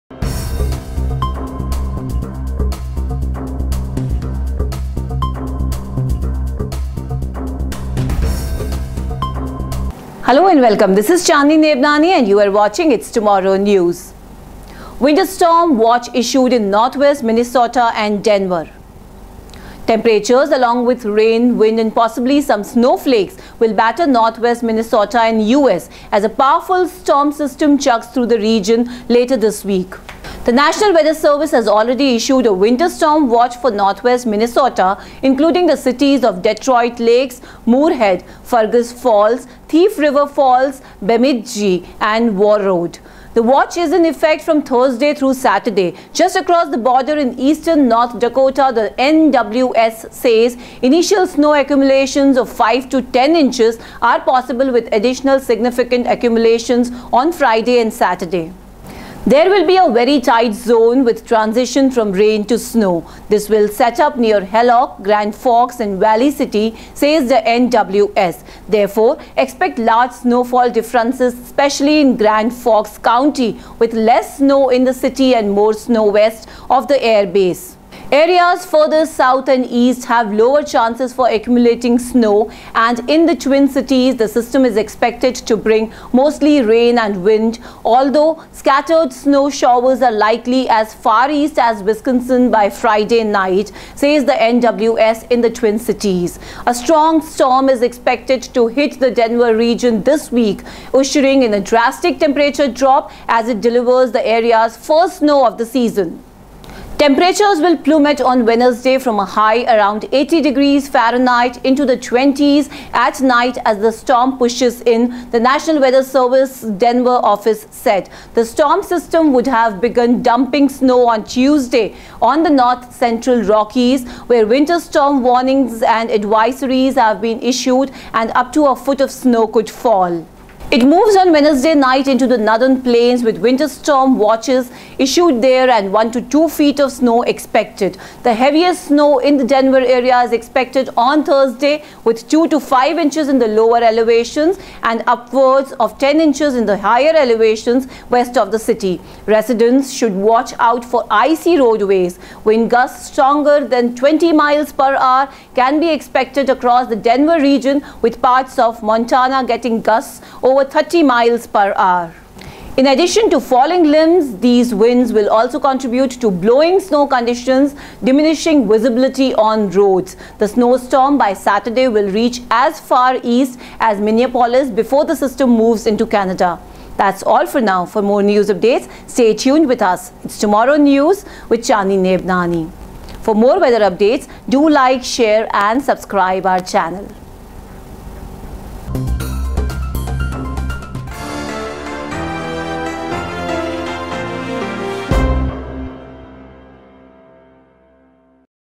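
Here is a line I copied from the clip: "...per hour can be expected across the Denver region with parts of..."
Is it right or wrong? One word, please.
right.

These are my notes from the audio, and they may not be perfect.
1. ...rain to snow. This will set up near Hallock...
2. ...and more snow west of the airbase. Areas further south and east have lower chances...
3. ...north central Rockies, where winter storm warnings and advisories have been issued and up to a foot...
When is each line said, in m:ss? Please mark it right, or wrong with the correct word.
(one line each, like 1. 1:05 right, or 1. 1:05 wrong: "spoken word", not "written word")
1. 1:02 right
2. 1:15 right
3. 2:02 right.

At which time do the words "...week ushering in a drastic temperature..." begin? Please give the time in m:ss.
1:40.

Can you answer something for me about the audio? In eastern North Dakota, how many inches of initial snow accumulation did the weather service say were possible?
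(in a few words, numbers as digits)
5 to 10 inches.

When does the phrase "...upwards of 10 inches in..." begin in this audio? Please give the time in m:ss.
2:25.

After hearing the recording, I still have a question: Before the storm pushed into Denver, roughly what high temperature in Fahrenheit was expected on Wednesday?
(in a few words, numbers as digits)
80 degrees.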